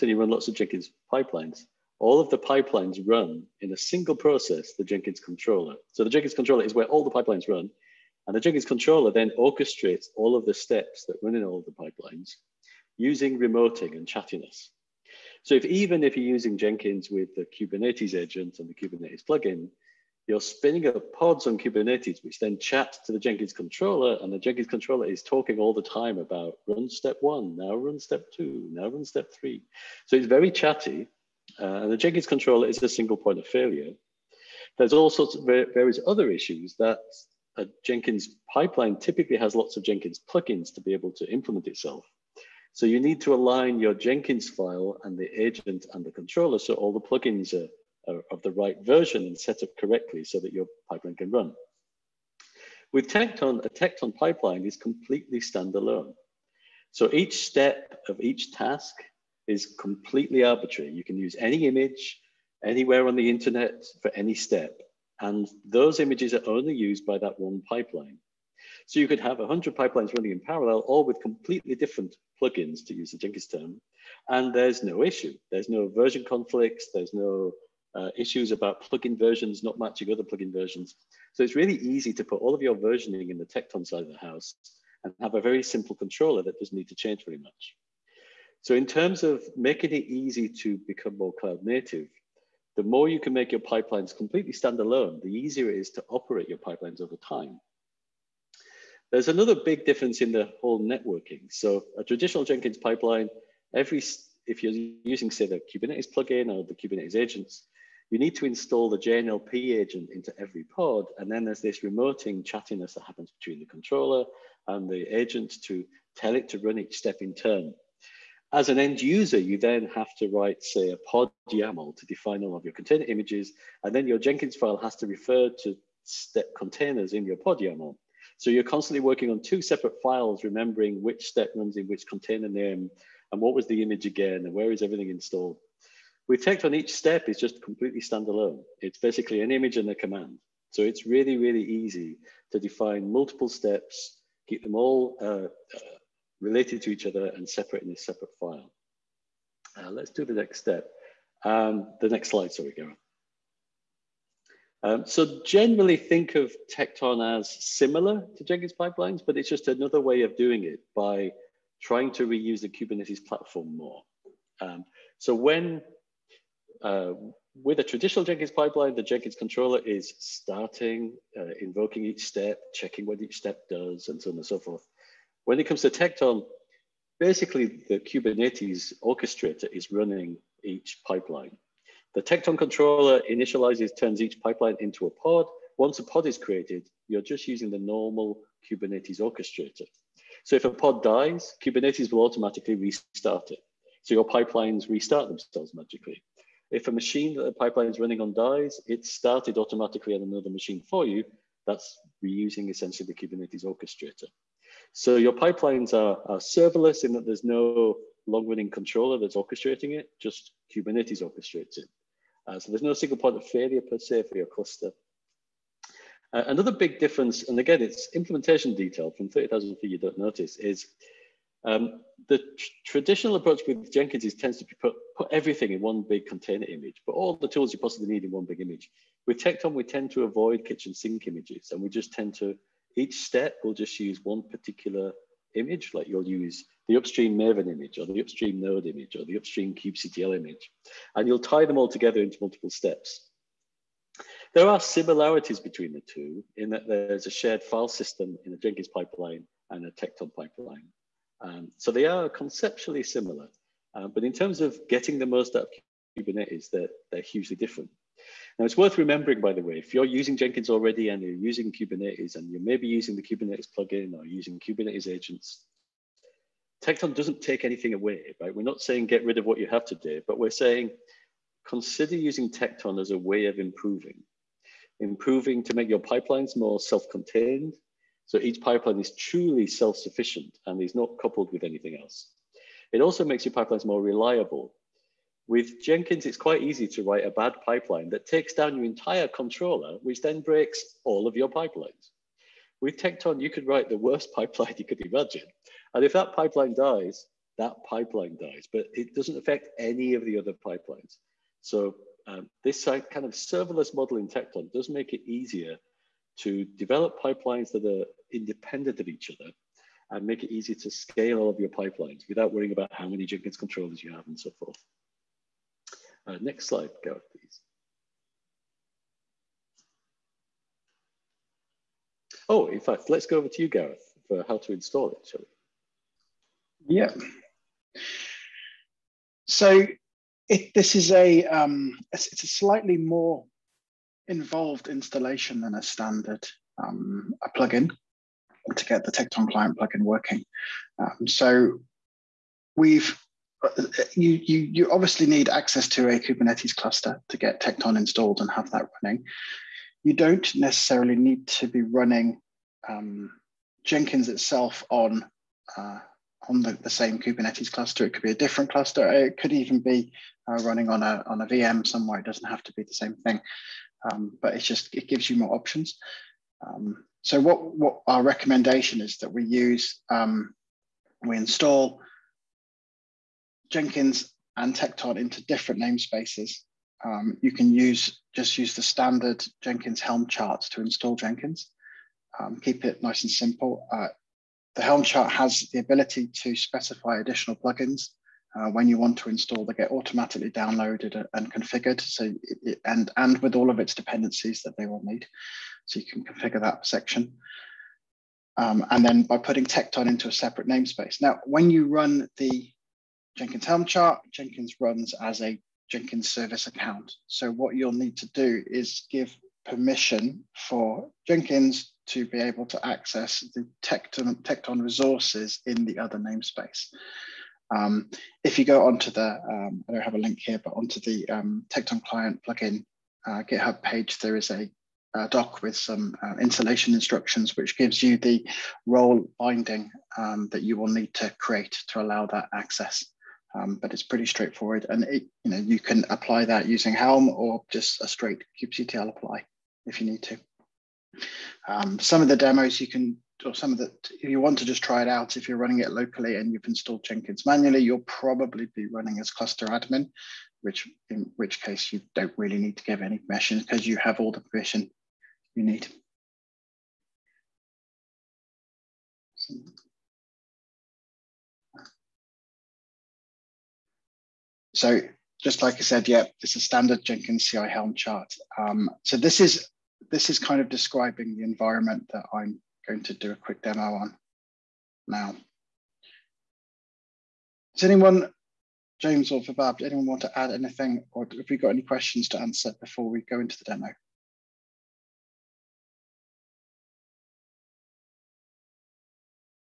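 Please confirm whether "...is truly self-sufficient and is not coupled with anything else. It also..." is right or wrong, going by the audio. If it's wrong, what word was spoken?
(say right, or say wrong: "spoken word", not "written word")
right.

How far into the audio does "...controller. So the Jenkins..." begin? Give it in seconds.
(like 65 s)
5 s.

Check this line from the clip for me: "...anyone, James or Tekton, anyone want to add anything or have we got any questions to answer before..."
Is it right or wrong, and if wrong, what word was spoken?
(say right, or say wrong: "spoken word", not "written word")
wrong: "Vibhav", not "Tekton".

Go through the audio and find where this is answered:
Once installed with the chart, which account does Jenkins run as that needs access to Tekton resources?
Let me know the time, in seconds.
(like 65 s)
405 s.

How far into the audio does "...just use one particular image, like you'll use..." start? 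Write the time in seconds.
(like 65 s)
233 s.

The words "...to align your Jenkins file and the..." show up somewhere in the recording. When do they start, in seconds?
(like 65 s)
43 s.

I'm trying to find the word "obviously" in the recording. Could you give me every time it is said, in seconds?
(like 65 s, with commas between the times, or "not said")
344 s.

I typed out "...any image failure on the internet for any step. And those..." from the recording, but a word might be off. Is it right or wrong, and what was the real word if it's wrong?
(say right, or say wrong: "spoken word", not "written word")
wrong: "anywhere", not "failure".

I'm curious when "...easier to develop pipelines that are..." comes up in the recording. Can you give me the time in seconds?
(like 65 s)
305 s.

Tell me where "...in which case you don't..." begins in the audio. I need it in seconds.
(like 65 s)
451 s.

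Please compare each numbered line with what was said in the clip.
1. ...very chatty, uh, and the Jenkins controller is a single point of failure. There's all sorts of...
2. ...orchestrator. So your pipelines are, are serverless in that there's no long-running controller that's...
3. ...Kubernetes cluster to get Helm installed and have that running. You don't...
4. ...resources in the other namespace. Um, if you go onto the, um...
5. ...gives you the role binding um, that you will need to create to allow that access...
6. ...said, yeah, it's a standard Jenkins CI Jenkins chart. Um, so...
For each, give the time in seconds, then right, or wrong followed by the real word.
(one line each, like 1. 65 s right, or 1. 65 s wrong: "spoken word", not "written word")
1. 30 s right
2. 203 s right
3. 346 s wrong: "Tekton", not "Helm"
4. 414 s right
5. 427 s right
6. 465 s wrong: "Helm", not "Jenkins".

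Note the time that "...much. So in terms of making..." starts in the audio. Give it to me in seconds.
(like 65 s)
87 s.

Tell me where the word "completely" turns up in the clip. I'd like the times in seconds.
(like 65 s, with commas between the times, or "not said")
54 s, 59 s, 71 s, 94 s, 137 s.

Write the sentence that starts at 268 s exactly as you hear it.
We're not saying get rid of what you have today, but we're saying consider using Tekton as a way of improving.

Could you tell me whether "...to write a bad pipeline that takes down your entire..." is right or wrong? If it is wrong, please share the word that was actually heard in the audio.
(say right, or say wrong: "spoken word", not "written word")
right.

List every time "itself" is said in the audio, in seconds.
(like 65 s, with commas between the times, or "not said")
41 s, 354 s.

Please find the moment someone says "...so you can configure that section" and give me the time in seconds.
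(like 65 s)
395 s.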